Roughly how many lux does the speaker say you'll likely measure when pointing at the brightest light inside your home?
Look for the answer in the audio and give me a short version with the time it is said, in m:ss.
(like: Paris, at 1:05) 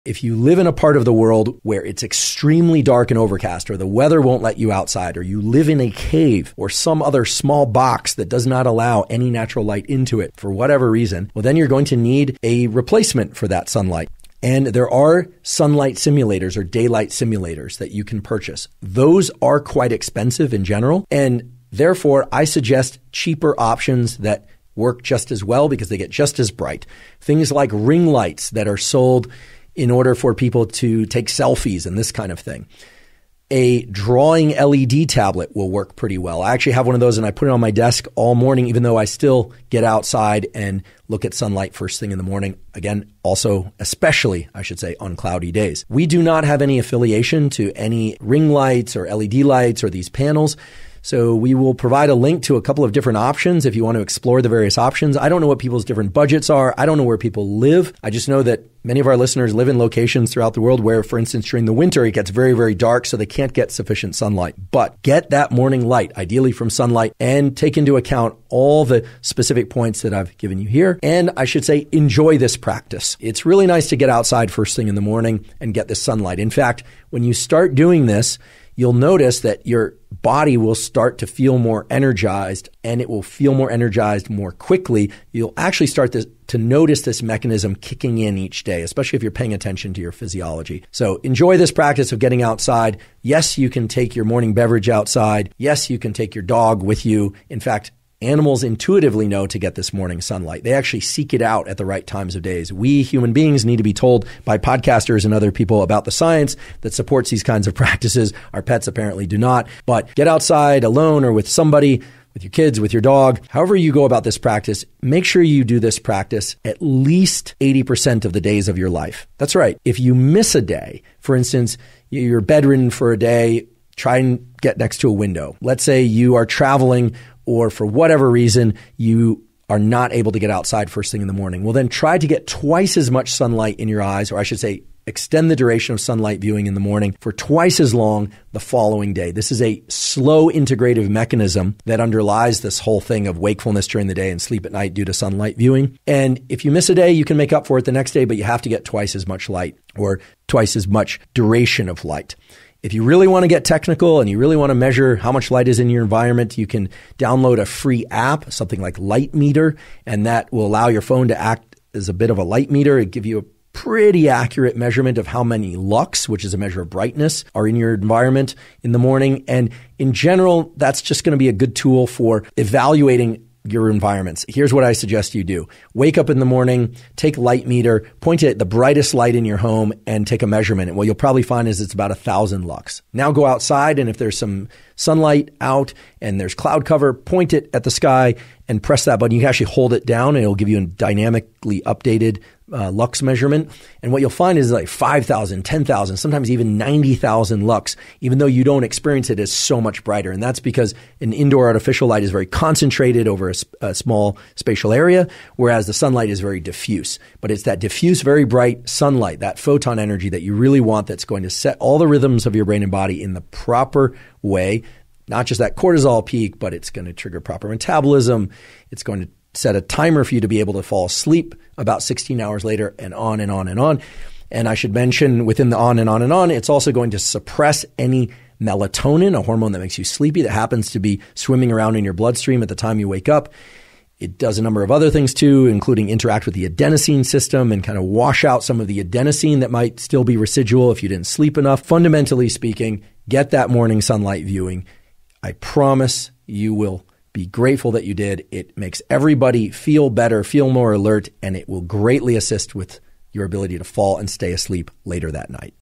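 1,000 lux, at 3:02.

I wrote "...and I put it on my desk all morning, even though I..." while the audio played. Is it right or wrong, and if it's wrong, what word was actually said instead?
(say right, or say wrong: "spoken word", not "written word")
right.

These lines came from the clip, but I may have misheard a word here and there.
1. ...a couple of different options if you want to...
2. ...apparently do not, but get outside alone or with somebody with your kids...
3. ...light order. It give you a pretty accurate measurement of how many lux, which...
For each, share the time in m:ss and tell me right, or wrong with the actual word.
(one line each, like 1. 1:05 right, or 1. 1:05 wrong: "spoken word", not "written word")
1. 0:52 right
2. 1:48 right
3. 2:42 wrong: "meter", not "order".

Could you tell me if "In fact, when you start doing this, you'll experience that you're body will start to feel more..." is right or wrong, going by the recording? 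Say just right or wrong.
wrong.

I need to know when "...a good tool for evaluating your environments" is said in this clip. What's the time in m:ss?
2:51.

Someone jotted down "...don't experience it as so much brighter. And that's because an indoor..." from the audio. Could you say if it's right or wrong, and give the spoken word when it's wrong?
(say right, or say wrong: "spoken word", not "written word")
right.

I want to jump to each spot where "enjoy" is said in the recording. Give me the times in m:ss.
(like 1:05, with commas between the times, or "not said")
1:11, 1:31.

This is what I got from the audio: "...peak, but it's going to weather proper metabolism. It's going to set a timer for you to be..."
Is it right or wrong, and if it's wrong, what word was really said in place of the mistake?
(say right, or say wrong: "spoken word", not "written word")
wrong: "trigger", not "weather".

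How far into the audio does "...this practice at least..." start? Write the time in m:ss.
1:55.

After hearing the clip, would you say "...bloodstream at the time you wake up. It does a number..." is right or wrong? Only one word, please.
right.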